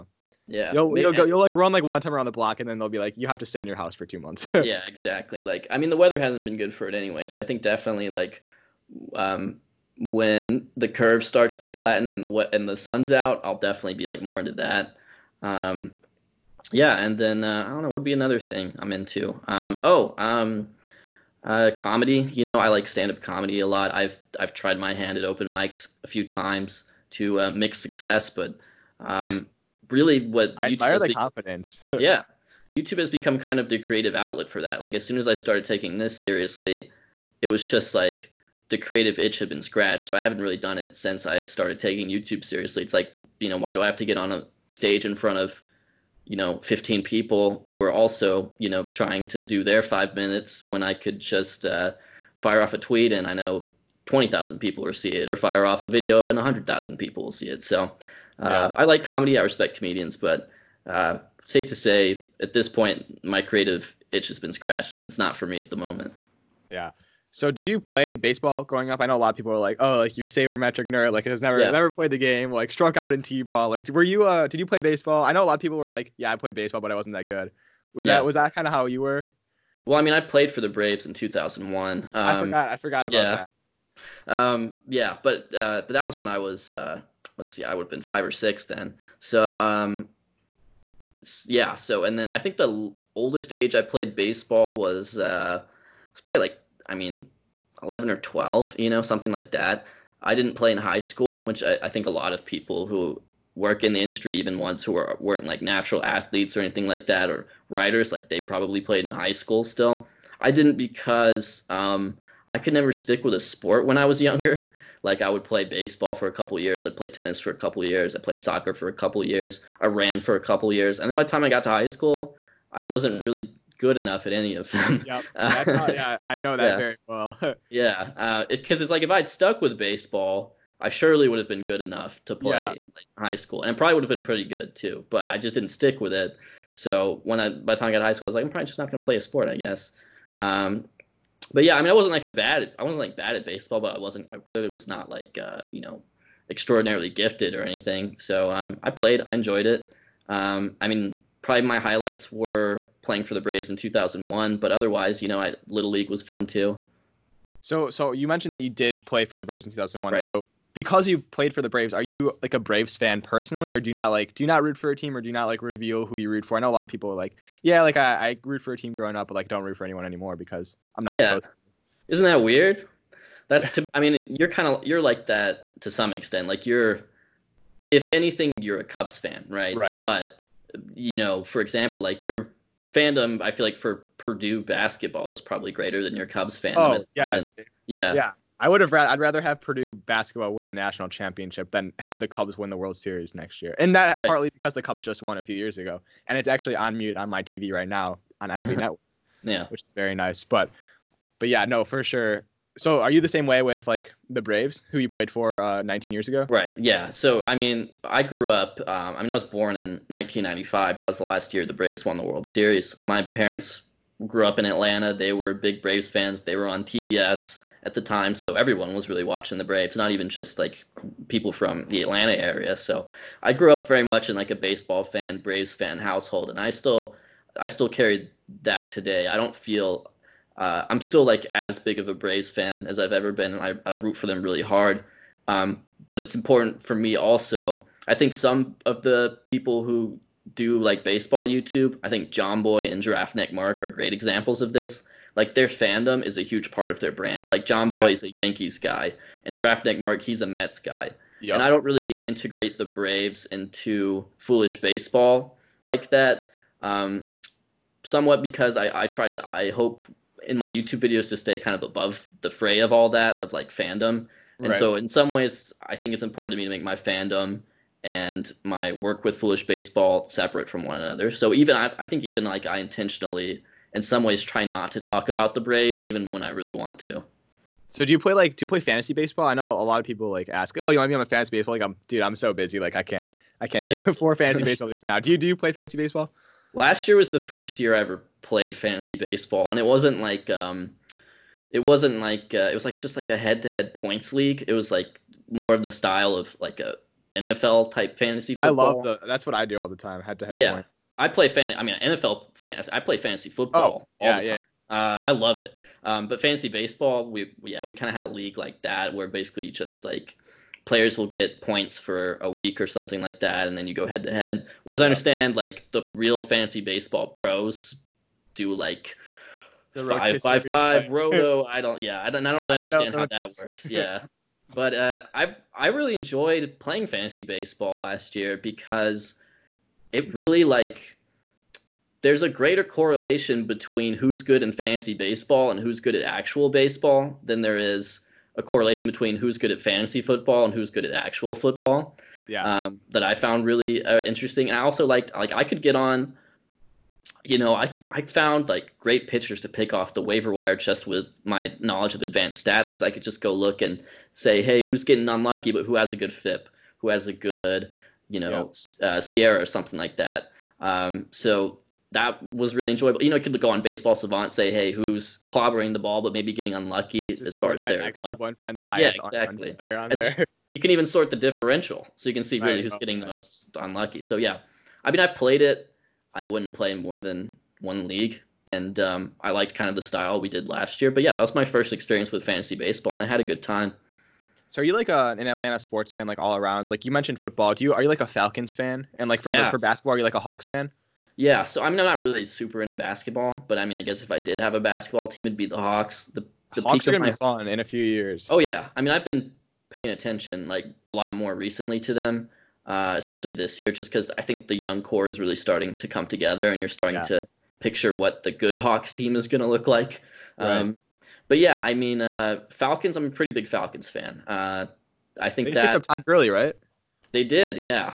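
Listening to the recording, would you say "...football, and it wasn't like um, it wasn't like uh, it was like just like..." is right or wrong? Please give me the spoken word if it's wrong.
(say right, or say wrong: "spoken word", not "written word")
wrong: "baseball", not "football".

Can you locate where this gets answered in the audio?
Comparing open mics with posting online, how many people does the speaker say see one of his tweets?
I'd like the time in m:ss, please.
0:54.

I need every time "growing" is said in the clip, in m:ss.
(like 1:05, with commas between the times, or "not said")
1:08, 2:48.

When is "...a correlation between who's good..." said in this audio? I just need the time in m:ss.
5:38.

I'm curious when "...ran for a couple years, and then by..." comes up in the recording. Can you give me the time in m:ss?
1:59.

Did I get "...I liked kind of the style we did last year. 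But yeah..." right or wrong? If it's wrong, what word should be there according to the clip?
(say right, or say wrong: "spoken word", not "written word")
right.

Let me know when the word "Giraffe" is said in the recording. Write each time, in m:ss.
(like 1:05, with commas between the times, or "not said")
4:03, 4:09.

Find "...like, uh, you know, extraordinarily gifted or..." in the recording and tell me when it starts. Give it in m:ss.
2:25.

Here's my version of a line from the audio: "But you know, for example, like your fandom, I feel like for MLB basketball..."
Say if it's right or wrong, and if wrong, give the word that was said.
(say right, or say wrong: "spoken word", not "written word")
wrong: "Purdue", not "MLB".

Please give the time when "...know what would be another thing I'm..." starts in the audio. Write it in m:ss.
0:17.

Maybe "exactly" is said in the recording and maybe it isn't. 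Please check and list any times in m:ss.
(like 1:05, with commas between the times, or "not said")
0:04, 6:09.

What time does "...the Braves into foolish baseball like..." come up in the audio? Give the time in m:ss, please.
4:12.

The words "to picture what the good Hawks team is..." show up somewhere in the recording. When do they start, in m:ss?
6:47.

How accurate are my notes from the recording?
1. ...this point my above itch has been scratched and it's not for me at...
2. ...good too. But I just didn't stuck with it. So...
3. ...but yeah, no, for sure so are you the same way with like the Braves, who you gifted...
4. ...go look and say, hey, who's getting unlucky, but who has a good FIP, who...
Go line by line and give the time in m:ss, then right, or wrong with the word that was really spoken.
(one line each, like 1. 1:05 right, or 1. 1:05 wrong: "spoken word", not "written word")
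1. 1:02 wrong: "creative", not "above"
2. 2:14 wrong: "stick", not "stuck"
3. 3:21 wrong: "played", not "gifted"
4. 5:53 right.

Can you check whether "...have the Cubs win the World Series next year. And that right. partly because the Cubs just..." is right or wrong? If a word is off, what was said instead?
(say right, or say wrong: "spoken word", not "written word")
right.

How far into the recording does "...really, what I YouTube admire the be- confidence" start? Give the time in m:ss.
0:29.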